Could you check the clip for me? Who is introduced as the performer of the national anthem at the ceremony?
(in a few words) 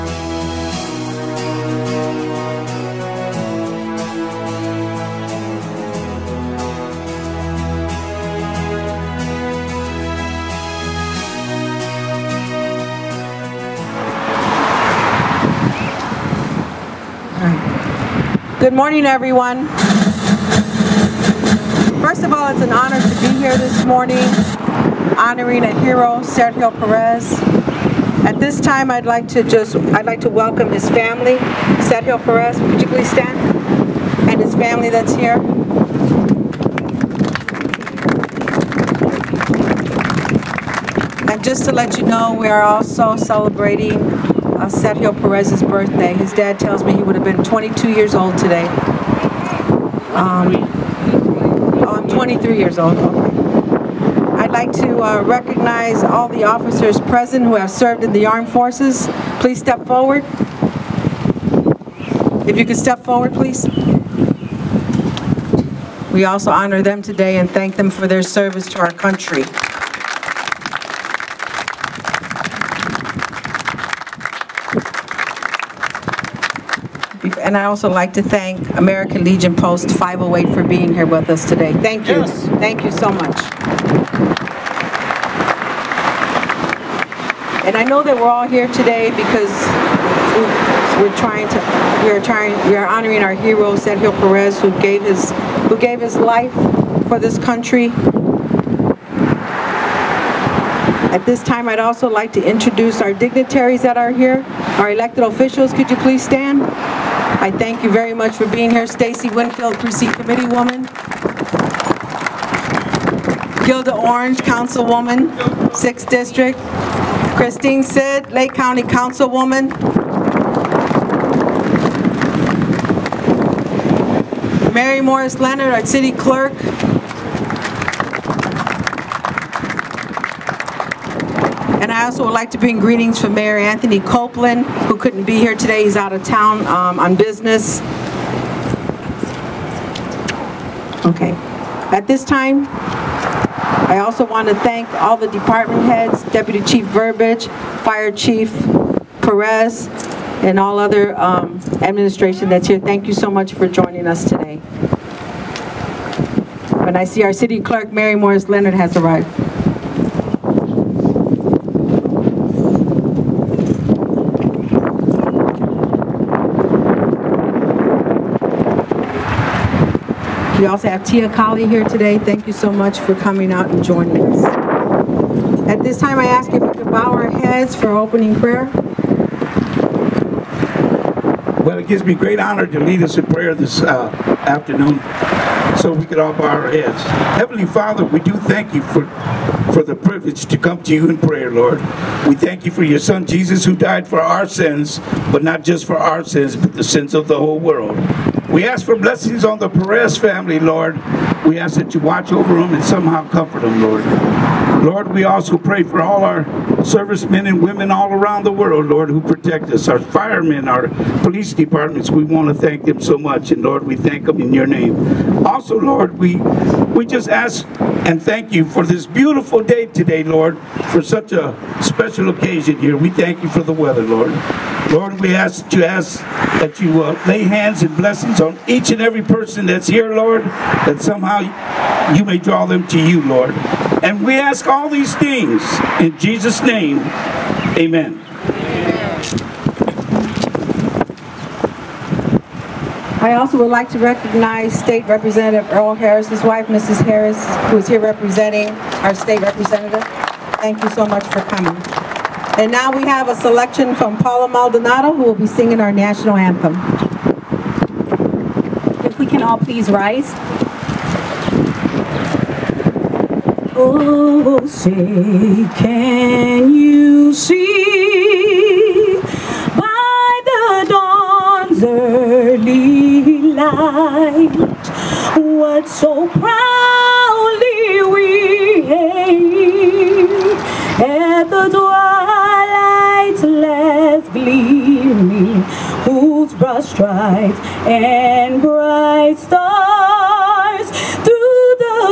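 Paula Maldonado.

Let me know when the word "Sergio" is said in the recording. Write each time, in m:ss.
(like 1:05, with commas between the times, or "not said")
0:26, 0:31, 0:44, 1:33.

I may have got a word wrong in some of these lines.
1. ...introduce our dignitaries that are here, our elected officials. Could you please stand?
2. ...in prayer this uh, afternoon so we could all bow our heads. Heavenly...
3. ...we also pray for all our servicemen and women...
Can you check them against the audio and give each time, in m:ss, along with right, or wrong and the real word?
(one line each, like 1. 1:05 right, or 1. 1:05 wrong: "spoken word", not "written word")
1. 1:42 right
2. 3:03 right
3. 3:25 right.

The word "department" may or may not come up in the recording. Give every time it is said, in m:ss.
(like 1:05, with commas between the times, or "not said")
2:25, 3:31.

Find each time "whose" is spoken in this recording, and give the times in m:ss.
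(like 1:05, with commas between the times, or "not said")
4:46.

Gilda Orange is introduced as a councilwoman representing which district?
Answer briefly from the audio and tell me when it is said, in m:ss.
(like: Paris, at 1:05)
6th District, at 1:55.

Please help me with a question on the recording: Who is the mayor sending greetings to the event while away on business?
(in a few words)
Anthony Copeland.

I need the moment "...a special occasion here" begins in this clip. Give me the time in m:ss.
3:41.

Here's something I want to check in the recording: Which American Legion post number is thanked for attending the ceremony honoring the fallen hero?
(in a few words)
508.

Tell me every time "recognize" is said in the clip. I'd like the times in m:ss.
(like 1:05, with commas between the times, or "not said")
0:55, 4:03.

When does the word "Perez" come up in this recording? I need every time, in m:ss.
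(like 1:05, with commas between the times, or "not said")
0:26, 0:32, 0:45, 1:34, 2:29, 3:19.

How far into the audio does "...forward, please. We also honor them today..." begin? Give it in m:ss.
1:03.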